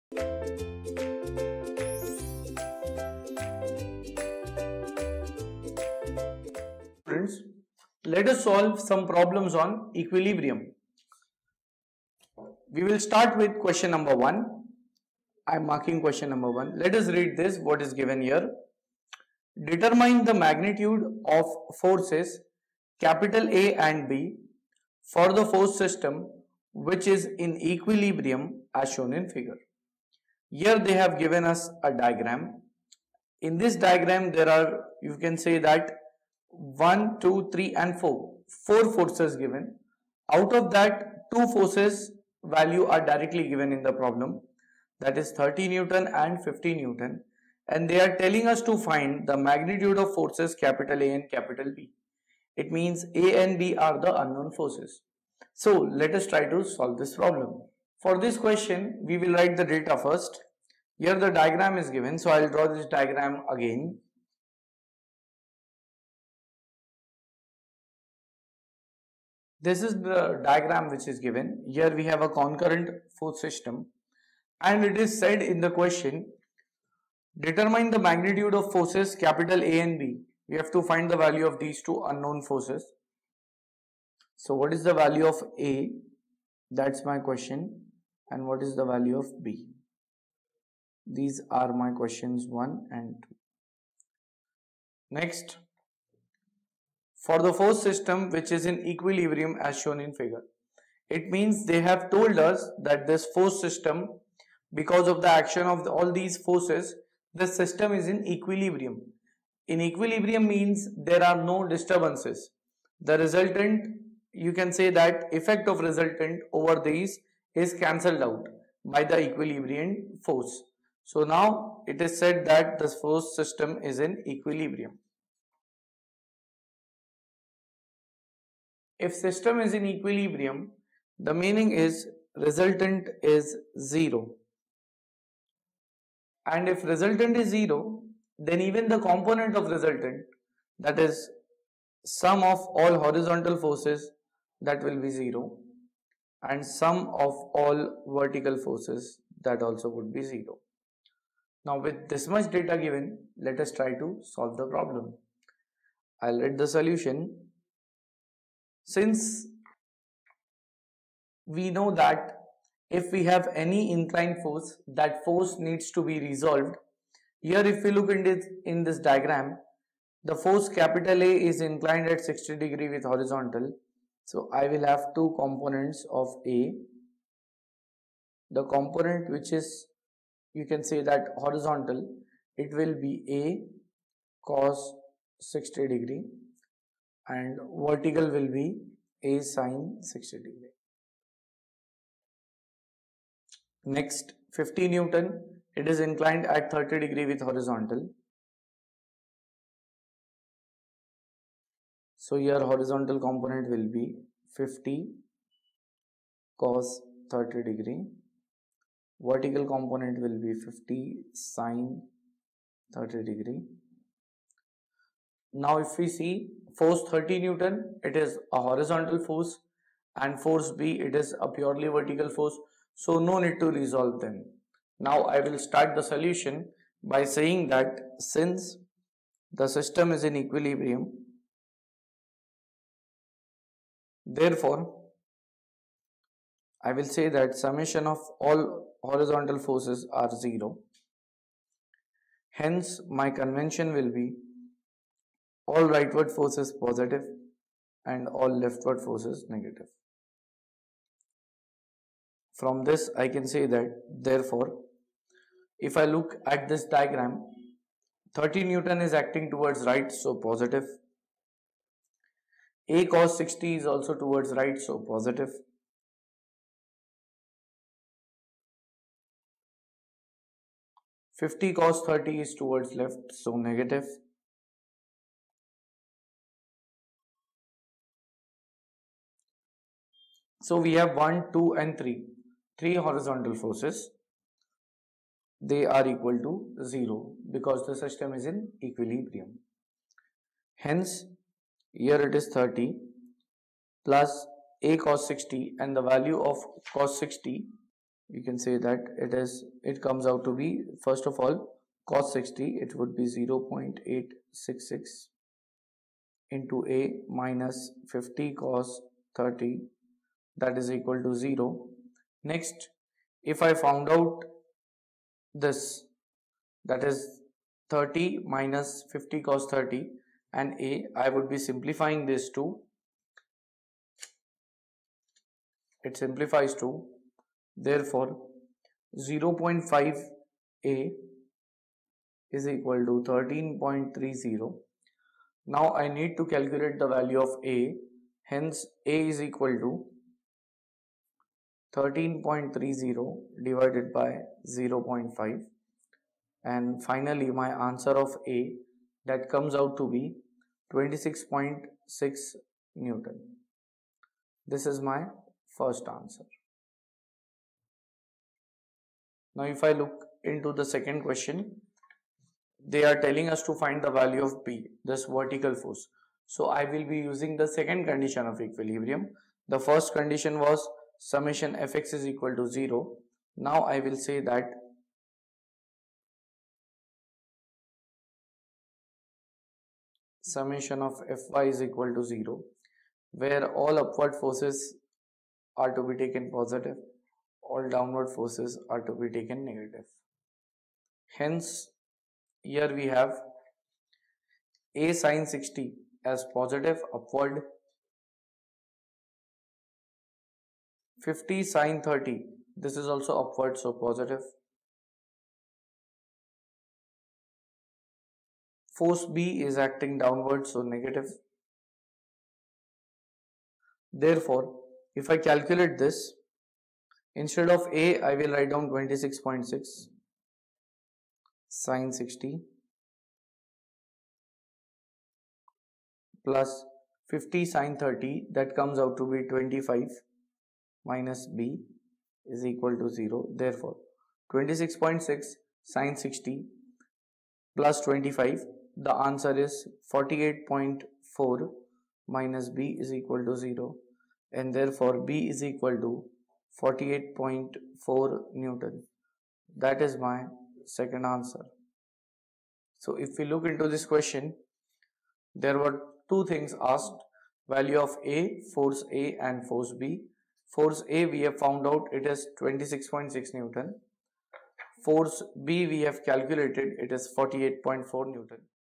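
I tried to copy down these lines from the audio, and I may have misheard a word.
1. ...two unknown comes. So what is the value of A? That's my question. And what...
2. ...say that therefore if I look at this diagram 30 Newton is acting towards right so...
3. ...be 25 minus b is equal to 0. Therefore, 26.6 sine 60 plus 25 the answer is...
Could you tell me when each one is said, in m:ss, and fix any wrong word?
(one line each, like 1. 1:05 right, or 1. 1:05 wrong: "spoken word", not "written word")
1. 1:21 wrong: "forces", not "comes"
2. 4:13 right
3. 7:09 right.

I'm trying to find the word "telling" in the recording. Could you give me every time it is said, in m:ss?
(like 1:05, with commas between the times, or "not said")
0:48, 6:03.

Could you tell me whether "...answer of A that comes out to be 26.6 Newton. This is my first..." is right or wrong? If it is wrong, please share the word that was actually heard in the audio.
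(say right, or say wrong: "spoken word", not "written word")
right.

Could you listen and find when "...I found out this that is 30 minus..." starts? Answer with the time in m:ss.
5:13.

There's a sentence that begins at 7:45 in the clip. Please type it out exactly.
Force B we have calculated it is 48.4 Newton.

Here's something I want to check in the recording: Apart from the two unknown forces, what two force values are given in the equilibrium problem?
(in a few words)
30 N and 50 N.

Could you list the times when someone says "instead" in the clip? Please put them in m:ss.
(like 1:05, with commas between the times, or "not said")
6:57.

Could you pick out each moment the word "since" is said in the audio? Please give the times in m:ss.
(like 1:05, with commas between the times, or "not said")
2:38, 3:48.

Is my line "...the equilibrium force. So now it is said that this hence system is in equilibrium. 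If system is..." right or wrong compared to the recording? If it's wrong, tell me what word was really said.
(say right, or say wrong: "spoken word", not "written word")
wrong: "force", not "hence".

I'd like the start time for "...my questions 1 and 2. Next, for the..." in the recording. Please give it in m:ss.
1:31.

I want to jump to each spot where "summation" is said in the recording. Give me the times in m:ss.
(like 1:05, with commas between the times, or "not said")
3:57, 6:11, 6:20.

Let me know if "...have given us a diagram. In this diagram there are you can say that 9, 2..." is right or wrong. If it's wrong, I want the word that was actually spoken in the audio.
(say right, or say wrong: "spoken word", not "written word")
wrong: "1", not "9".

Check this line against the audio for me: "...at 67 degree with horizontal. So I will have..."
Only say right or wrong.
wrong.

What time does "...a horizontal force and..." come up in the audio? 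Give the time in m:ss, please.
3:38.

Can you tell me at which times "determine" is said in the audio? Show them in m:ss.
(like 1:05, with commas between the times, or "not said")
0:19, 1:17.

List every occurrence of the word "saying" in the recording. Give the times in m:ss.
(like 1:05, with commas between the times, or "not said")
3:47.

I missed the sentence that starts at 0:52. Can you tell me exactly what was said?
It means A and B are the unknown forces.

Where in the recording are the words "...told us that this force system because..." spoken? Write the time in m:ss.
1:42.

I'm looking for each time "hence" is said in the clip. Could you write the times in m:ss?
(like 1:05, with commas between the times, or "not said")
4:02, 4:50, 5:38, 6:31.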